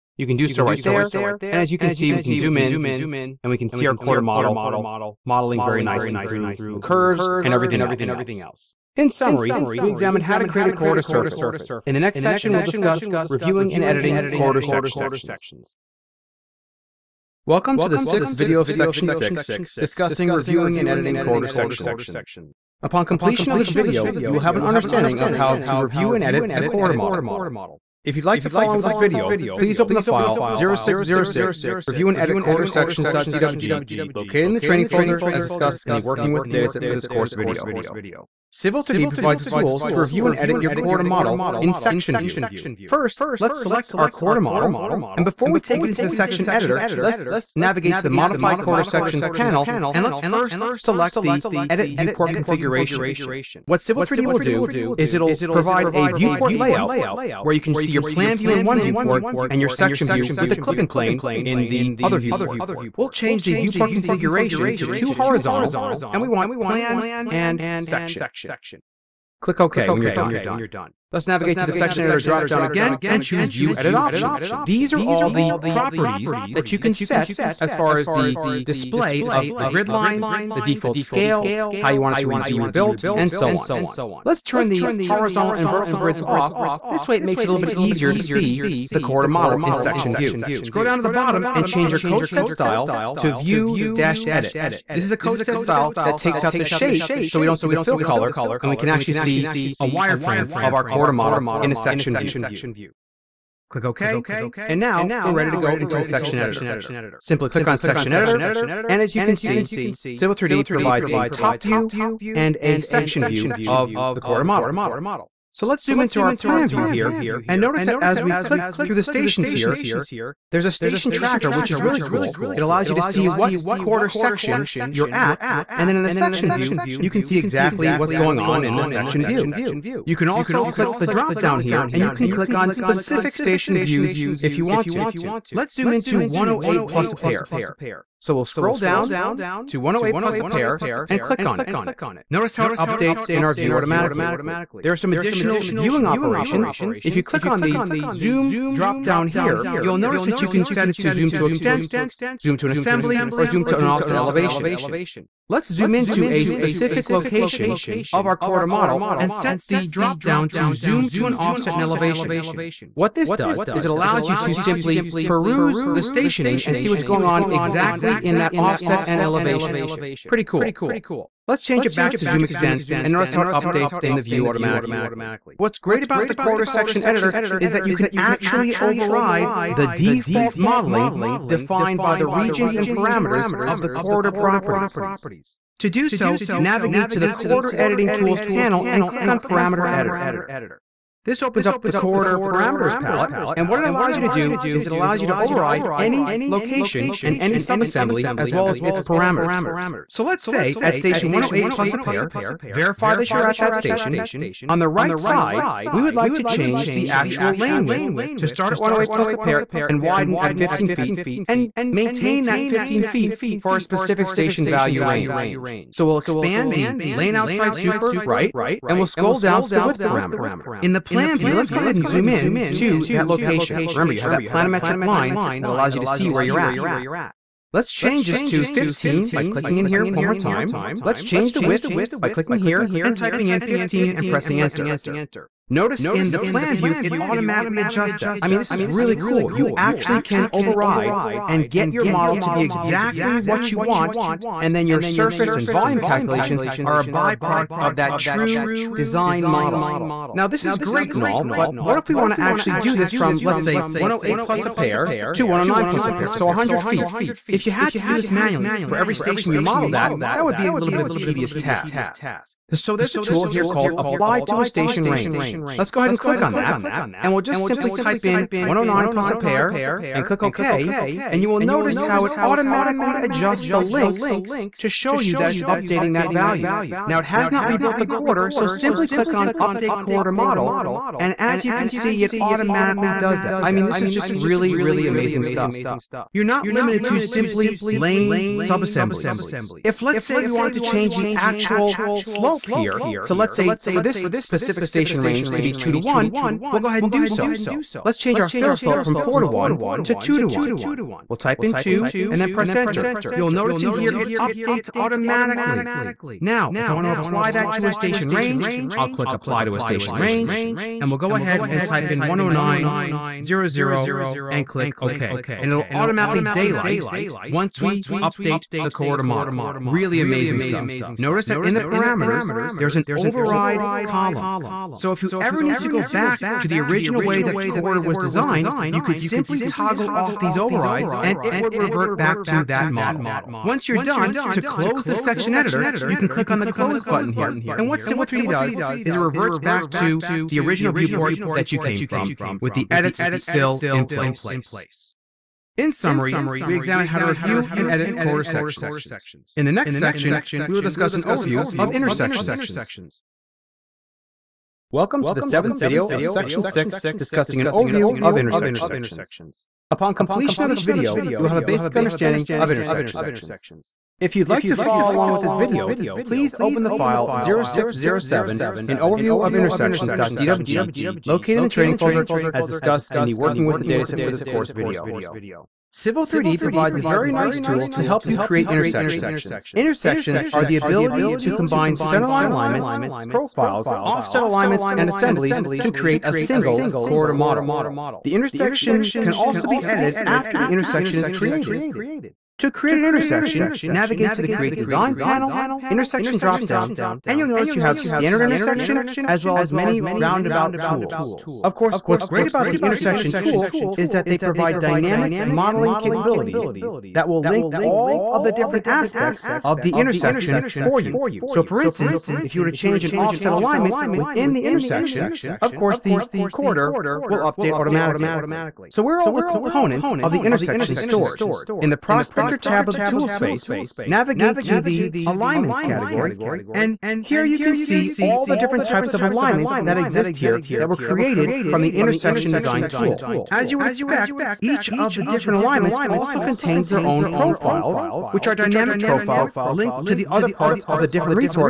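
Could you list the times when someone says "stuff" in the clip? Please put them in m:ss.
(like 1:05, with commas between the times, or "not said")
4:45, 5:20.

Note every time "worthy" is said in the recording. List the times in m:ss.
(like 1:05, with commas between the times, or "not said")
not said.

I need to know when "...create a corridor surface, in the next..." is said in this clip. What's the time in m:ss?
0:10.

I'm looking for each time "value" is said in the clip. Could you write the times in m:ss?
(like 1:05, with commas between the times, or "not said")
3:34, 4:36.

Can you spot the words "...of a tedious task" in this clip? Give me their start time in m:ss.
4:21.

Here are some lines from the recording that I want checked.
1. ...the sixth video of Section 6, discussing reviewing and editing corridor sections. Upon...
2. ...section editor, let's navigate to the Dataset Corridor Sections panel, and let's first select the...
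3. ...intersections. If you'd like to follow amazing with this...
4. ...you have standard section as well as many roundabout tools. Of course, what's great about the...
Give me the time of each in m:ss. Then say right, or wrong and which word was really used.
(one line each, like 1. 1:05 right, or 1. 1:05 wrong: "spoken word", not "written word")
1. 0:17 right
2. 0:46 wrong: "Modified", not "Dataset"
3. 6:02 wrong: "along", not "amazing"
4. 6:37 wrong: "intersection", not "section".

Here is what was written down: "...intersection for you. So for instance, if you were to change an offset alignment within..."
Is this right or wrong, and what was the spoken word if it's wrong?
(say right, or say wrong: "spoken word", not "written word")
right.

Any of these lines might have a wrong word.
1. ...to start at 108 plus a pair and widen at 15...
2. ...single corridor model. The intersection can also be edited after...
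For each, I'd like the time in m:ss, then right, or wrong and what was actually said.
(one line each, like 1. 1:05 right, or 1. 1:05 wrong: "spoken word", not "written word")
1. 3:28 right
2. 6:26 right.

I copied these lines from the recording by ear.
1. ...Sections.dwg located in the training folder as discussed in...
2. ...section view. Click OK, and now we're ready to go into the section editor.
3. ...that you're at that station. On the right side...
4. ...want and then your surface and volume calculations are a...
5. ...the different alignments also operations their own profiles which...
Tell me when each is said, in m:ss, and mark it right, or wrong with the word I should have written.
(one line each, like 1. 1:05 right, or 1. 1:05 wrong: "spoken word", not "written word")
1. 0:32 right
2. 1:41 right
3. 3:23 right
4. 4:03 right
5. 7:15 wrong: "contains", not "operations".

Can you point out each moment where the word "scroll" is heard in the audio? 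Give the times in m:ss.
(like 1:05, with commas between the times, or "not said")
1:30, 2:18, 3:39.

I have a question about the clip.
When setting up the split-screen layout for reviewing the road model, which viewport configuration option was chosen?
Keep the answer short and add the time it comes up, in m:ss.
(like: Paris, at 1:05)
two horizontal, at 1:04.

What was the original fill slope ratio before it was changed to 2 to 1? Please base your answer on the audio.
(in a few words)
4 to 1.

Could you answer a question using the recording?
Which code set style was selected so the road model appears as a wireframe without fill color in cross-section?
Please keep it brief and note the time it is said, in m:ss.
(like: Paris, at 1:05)
view-edit, at 1:33.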